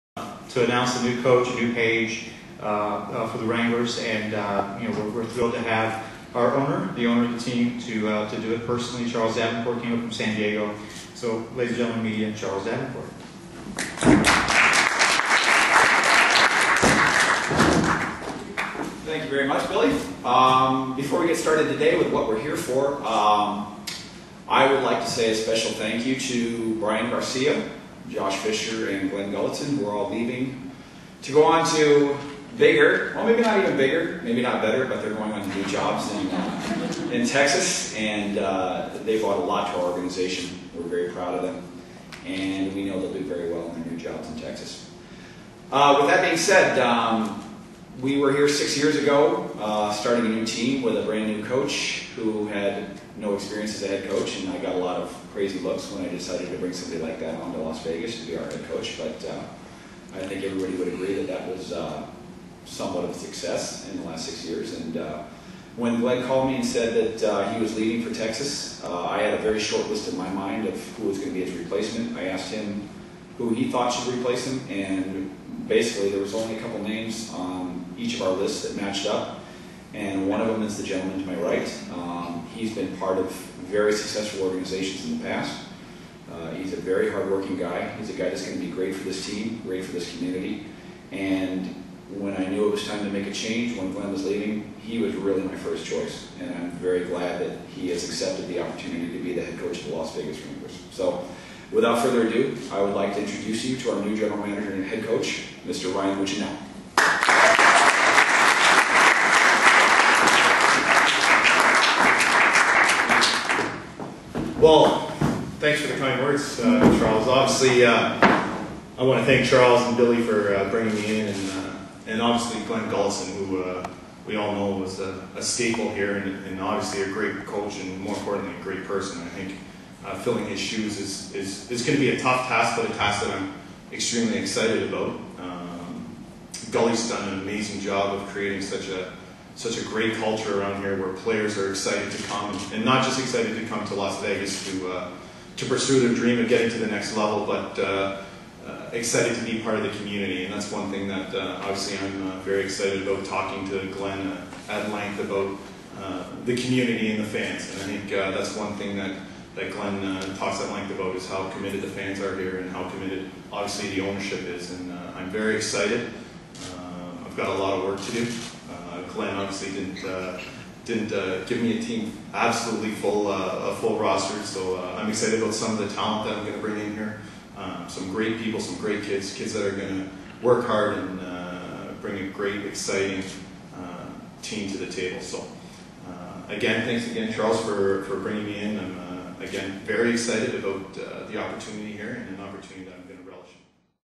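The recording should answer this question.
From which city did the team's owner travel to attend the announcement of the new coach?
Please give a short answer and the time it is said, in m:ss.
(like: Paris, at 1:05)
San Diego, at 0:10.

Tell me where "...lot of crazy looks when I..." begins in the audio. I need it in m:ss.
0:54.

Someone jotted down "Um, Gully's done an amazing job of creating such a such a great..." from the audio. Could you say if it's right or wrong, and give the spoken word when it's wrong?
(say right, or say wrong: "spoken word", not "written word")
right.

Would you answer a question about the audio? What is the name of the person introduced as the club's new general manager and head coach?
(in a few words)
Ryan Mougenel.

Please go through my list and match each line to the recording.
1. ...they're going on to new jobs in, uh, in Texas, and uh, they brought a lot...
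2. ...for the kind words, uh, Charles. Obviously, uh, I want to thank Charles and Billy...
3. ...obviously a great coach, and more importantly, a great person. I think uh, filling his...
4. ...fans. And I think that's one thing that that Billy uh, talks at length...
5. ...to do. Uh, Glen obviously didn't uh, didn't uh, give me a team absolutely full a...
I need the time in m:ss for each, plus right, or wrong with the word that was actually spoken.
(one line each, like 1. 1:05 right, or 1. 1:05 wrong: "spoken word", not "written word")
1. 0:35 right
2. 1:55 right
3. 2:06 right
4. 2:37 wrong: "Glen", not "Billy"
5. 2:48 right.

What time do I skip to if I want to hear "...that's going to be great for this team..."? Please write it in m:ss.
1:28.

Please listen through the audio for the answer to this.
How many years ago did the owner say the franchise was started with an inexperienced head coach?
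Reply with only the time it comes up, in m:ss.
0:48.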